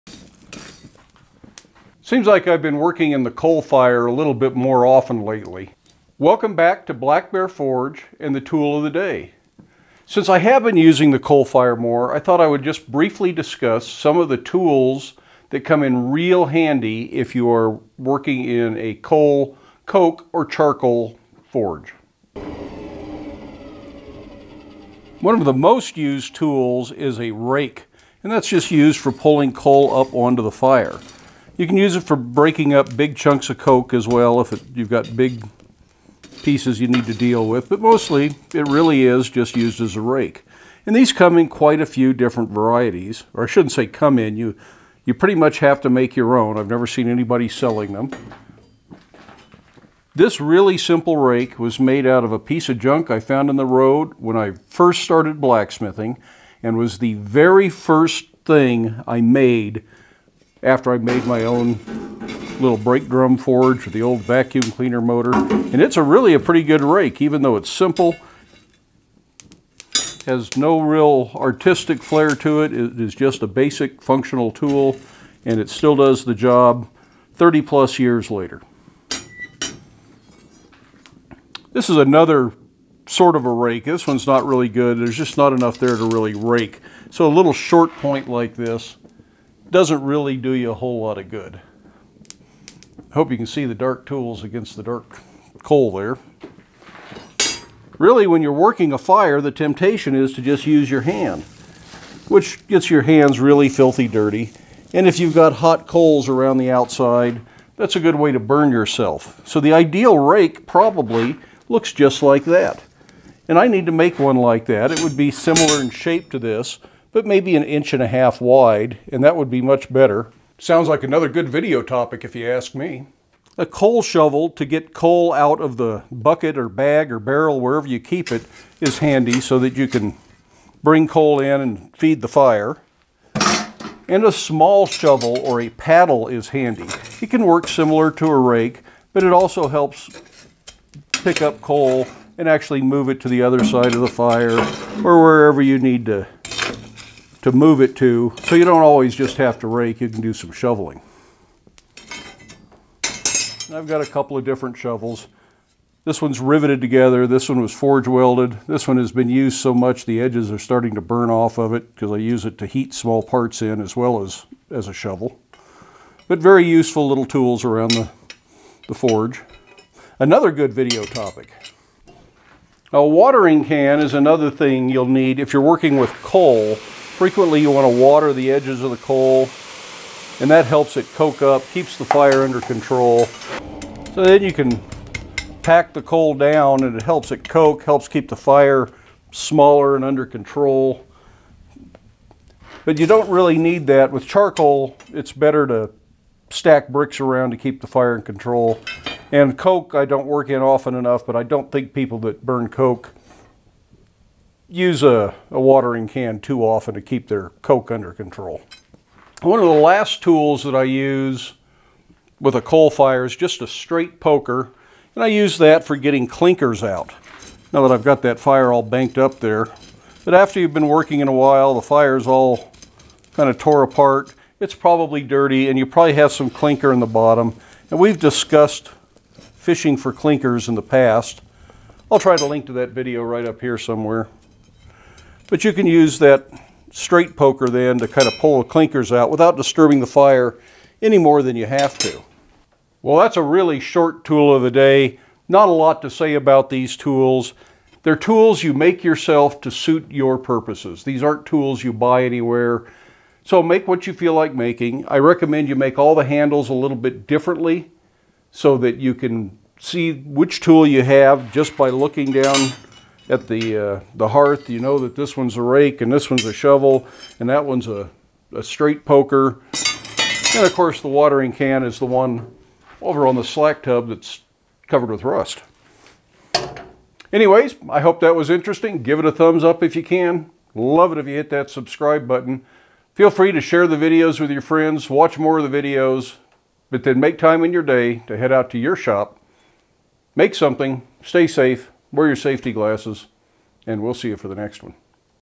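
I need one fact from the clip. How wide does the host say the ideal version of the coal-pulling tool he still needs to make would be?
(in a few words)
an inch and a half.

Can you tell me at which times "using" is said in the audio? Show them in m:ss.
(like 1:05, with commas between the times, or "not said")
0:10.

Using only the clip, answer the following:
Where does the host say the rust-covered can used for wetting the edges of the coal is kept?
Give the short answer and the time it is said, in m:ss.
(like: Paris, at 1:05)
on the slack tub, at 4:33.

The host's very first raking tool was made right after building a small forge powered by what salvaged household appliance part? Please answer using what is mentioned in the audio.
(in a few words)
vacuum cleaner motor.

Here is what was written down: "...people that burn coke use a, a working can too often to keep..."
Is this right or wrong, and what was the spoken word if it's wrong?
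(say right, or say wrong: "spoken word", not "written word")
wrong: "watering", not "working".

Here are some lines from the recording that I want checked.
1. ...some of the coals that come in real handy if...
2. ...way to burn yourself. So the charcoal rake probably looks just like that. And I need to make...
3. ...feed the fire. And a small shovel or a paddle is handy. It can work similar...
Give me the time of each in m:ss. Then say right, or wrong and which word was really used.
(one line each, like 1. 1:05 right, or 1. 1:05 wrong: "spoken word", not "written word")
1. 0:13 wrong: "tools", not "coals"
2. 1:48 wrong: "ideal", not "charcoal"
3. 2:11 right.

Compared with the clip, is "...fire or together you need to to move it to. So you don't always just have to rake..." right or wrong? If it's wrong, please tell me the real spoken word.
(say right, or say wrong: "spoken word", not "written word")
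wrong: "wherever", not "together".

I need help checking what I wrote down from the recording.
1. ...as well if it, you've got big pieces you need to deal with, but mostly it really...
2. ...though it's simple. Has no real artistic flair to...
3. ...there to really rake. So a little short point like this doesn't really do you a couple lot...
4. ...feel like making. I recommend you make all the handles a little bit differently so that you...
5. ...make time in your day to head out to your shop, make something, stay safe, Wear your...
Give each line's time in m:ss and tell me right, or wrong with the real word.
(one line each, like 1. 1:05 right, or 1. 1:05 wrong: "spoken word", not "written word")
1. 0:33 right
2. 1:07 right
3. 1:25 wrong: "whole", not "couple"
4. 4:14 right
5. 4:47 right.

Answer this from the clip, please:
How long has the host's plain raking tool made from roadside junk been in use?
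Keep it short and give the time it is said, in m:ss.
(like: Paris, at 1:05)
30 plus years, at 1:17.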